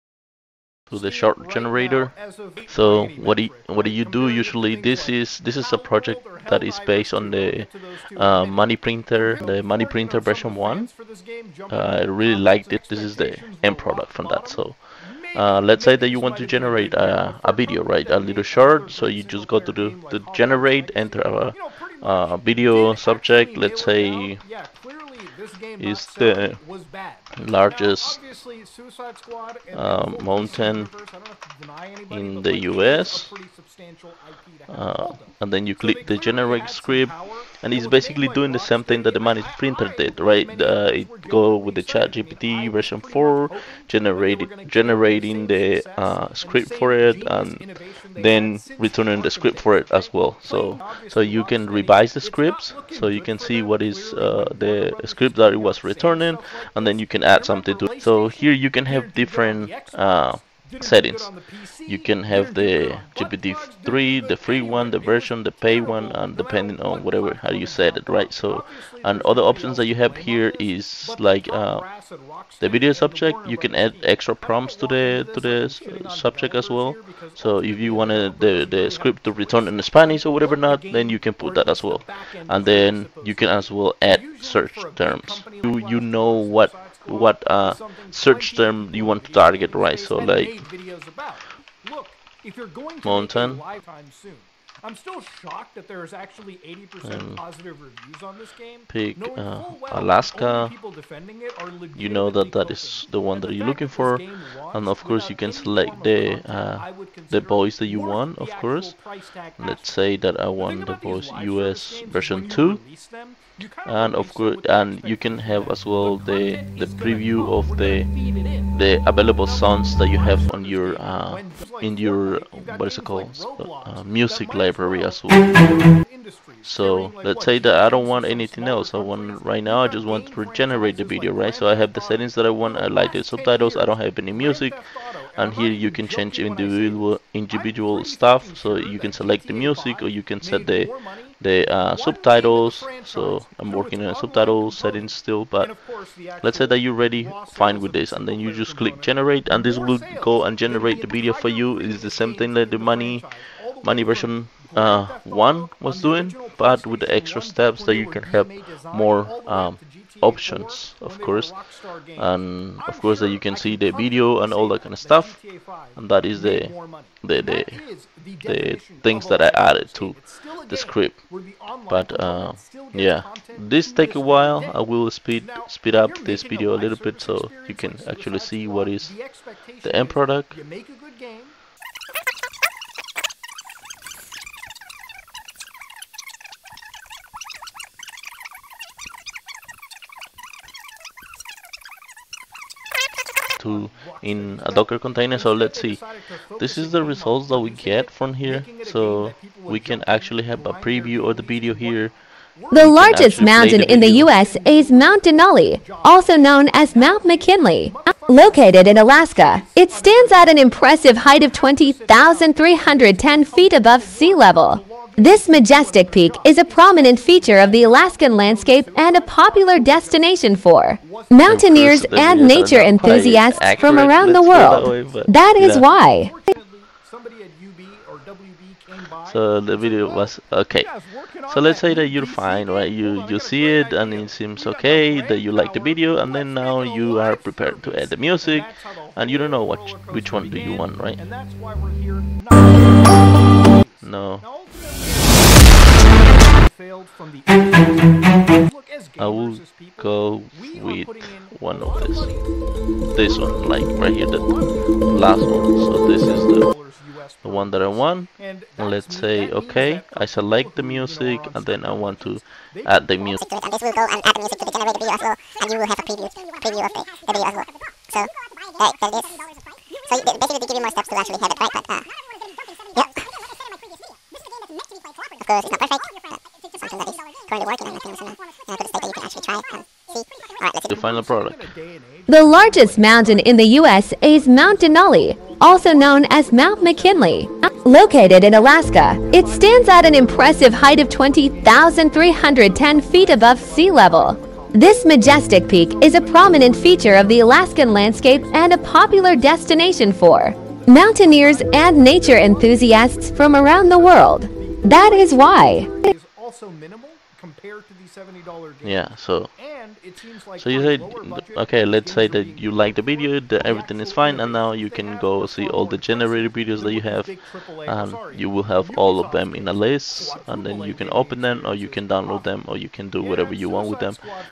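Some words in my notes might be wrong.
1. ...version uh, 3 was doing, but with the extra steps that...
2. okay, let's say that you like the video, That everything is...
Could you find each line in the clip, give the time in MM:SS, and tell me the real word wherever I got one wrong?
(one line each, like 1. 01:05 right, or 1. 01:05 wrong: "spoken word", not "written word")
1. 02:34 wrong: "1", not "3"
2. 05:11 right.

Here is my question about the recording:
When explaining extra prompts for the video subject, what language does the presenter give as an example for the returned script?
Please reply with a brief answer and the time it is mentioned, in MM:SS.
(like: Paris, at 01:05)
Spanish, at 01:19.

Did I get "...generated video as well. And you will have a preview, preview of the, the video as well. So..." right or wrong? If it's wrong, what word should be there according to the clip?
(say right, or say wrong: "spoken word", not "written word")
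right.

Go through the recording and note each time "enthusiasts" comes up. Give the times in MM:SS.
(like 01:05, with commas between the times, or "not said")
03:42, 05:02.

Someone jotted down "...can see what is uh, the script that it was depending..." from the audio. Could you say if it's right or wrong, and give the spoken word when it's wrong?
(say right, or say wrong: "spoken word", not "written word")
wrong: "returning", not "depending".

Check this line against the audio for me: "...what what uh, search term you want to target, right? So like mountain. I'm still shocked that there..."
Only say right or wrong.
right.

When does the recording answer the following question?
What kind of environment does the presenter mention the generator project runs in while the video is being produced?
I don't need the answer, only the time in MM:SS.
03:14.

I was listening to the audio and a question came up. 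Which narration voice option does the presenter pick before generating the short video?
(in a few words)
US version 2.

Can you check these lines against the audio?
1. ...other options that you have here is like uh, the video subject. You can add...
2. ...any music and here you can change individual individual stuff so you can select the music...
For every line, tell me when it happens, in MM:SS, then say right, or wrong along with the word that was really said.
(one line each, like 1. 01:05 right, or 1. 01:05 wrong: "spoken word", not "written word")
1. 01:09 right
2. 02:14 right.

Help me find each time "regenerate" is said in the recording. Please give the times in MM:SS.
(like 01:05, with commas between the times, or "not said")
02:10.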